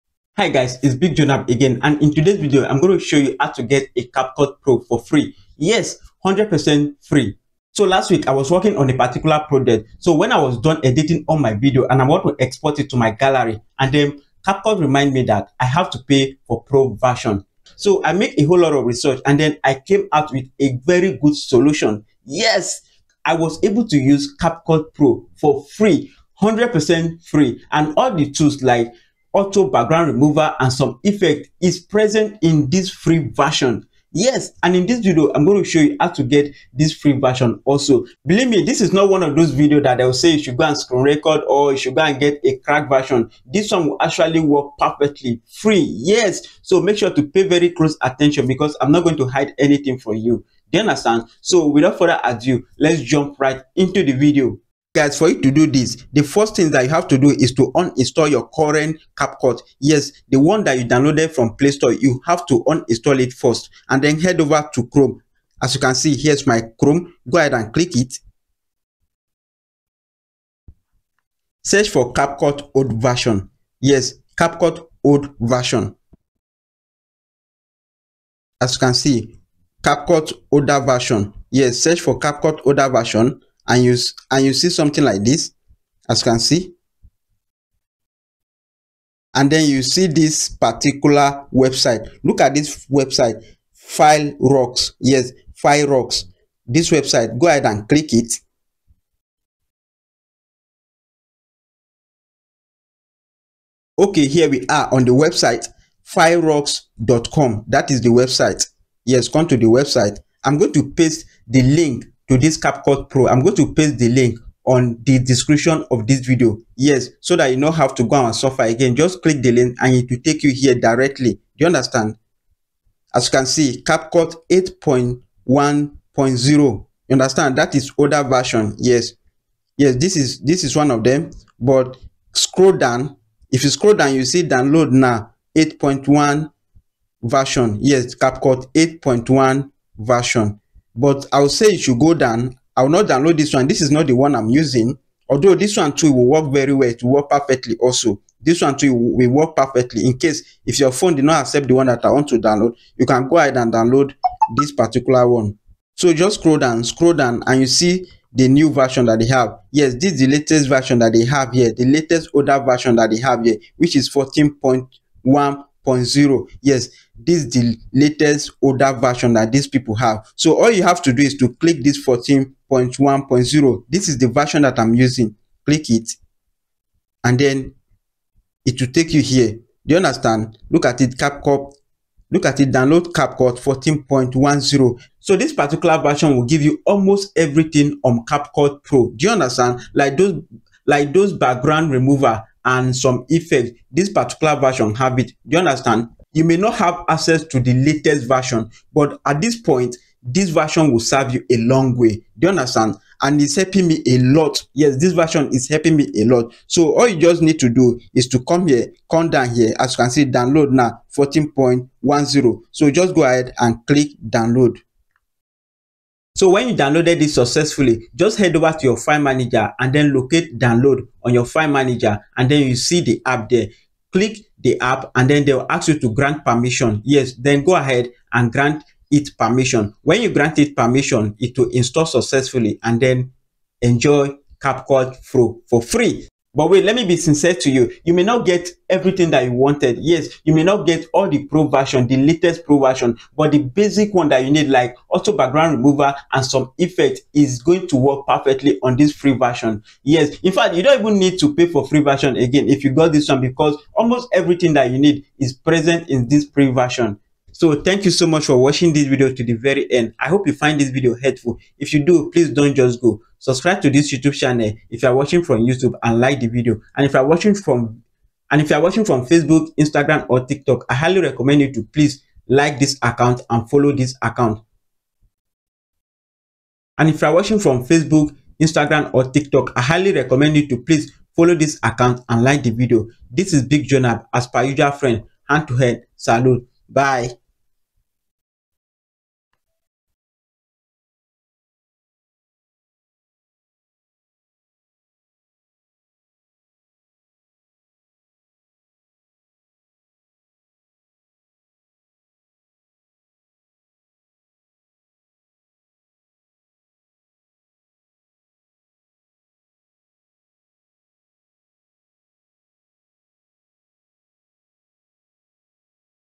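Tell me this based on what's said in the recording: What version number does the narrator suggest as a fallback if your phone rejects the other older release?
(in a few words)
8.1.0.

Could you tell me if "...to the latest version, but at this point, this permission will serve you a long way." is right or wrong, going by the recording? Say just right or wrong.
wrong.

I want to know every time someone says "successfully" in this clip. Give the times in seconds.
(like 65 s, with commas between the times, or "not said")
217 s, 232 s.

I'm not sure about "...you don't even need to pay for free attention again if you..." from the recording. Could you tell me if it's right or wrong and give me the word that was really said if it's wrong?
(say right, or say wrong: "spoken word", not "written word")
wrong: "version", not "attention".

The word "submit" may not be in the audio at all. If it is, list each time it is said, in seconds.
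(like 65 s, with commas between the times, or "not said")
not said.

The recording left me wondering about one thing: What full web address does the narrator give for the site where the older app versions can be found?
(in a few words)
filerox.com.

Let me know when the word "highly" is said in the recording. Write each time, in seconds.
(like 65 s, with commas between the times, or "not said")
270 s, 279 s.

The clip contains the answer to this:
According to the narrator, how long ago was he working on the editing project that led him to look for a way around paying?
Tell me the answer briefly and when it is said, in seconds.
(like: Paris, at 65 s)
last week, at 7 s.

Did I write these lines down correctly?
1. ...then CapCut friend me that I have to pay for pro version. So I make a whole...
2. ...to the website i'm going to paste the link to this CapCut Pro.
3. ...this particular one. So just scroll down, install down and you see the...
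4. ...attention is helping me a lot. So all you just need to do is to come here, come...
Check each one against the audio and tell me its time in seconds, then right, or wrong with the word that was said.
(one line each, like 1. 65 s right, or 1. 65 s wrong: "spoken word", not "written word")
1. 13 s wrong: "remind", not "friend"
2. 109 s right
3. 154 s wrong: "scroll", not "install"
4. 205 s wrong: "version", not "attention".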